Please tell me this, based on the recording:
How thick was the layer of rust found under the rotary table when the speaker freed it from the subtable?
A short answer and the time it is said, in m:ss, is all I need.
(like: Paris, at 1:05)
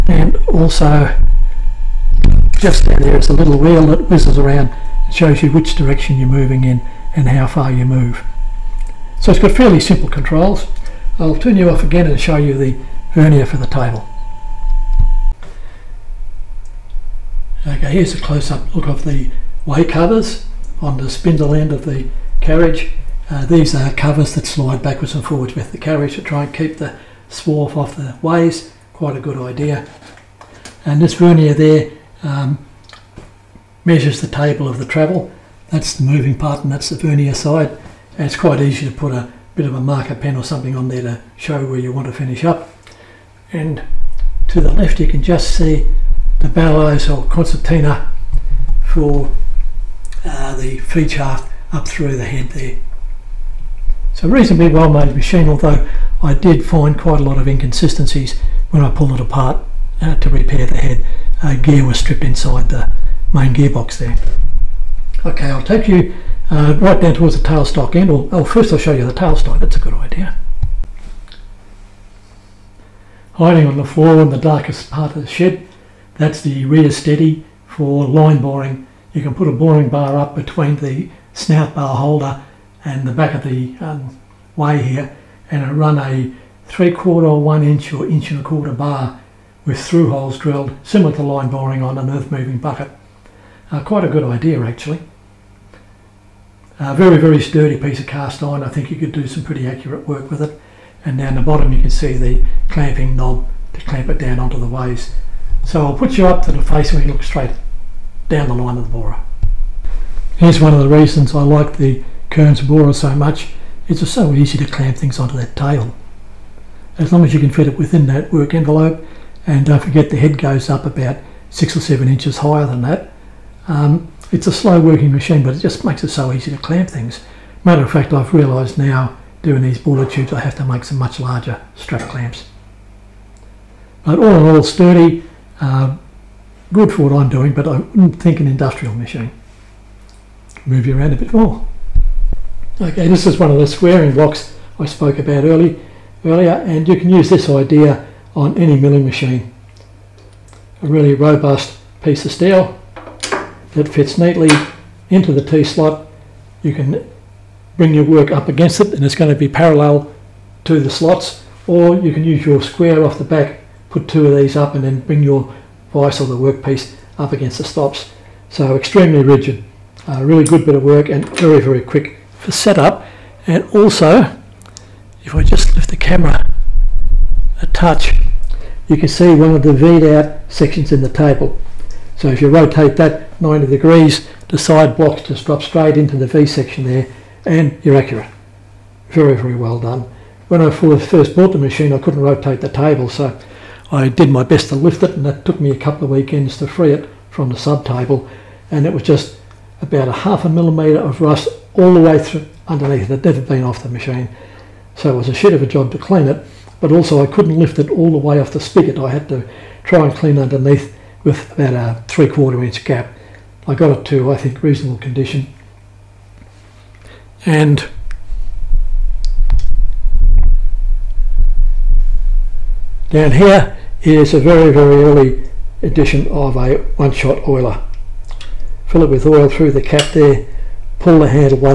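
Half a millimetre, at 3:20.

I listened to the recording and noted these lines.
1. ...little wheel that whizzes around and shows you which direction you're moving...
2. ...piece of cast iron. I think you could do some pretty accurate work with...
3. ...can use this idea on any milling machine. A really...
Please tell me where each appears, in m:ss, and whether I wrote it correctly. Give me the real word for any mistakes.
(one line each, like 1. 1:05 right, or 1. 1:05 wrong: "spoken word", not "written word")
1. 0:03 right
2. 1:37 right
3. 2:26 right.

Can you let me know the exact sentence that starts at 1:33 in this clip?
Uh, quite a good idea actually.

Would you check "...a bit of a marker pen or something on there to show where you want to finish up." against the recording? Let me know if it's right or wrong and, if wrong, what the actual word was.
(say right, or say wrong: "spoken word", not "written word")
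right.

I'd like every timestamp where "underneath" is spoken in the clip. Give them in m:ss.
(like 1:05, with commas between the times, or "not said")
3:22, 3:30.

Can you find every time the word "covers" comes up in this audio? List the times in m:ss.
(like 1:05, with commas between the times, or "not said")
0:19, 0:23.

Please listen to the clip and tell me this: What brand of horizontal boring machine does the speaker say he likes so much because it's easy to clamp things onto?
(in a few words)
Kearns.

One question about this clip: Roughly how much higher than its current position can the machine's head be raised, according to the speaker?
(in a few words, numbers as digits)
6 or 7 inches.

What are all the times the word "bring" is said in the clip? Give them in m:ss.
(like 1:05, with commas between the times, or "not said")
2:37, 2:45.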